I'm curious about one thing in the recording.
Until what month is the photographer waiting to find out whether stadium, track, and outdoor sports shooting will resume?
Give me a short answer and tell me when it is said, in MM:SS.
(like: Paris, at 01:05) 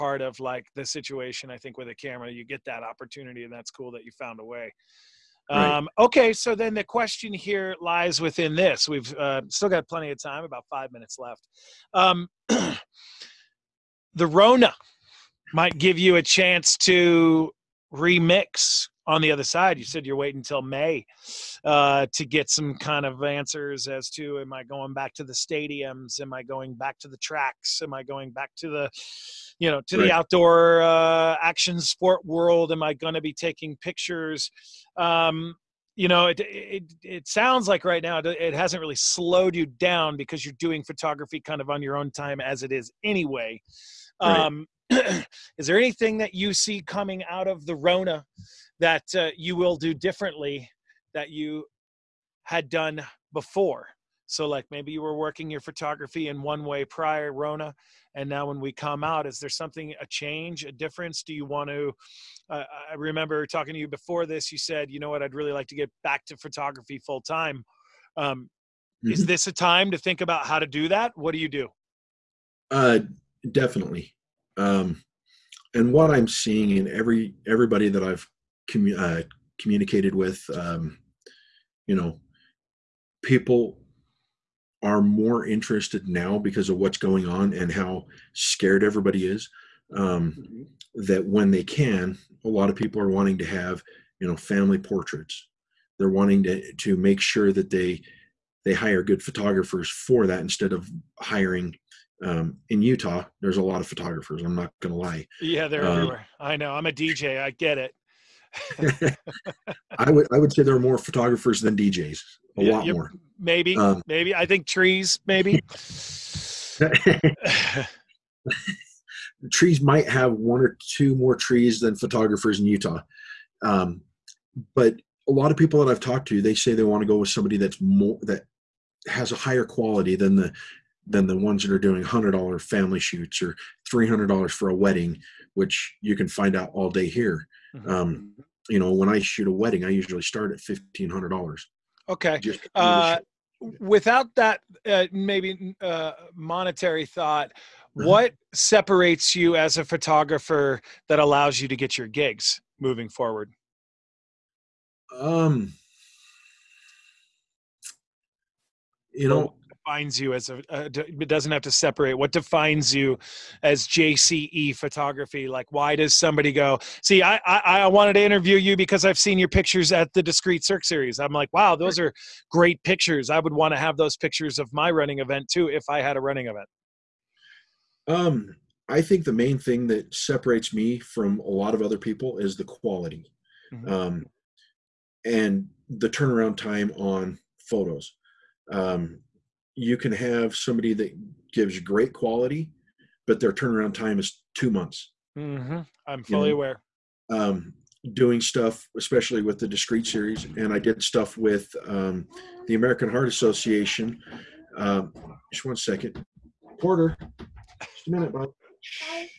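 May, at 00:20.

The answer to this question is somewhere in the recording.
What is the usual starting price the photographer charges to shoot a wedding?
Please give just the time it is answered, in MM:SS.
02:20.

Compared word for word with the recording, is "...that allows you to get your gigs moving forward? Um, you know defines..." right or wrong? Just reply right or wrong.
right.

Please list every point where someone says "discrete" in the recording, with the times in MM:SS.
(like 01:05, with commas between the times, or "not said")
02:50, 03:19.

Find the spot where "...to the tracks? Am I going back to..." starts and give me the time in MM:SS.
00:26.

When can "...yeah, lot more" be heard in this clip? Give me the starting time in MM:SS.
01:52.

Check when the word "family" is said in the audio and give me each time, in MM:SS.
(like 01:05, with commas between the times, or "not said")
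01:34, 02:12.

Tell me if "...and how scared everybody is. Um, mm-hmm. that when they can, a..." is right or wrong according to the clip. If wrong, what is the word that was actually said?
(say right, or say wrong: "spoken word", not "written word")
right.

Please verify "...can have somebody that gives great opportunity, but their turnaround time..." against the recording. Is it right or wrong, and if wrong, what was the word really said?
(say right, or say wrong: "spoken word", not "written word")
wrong: "quality", not "opportunity".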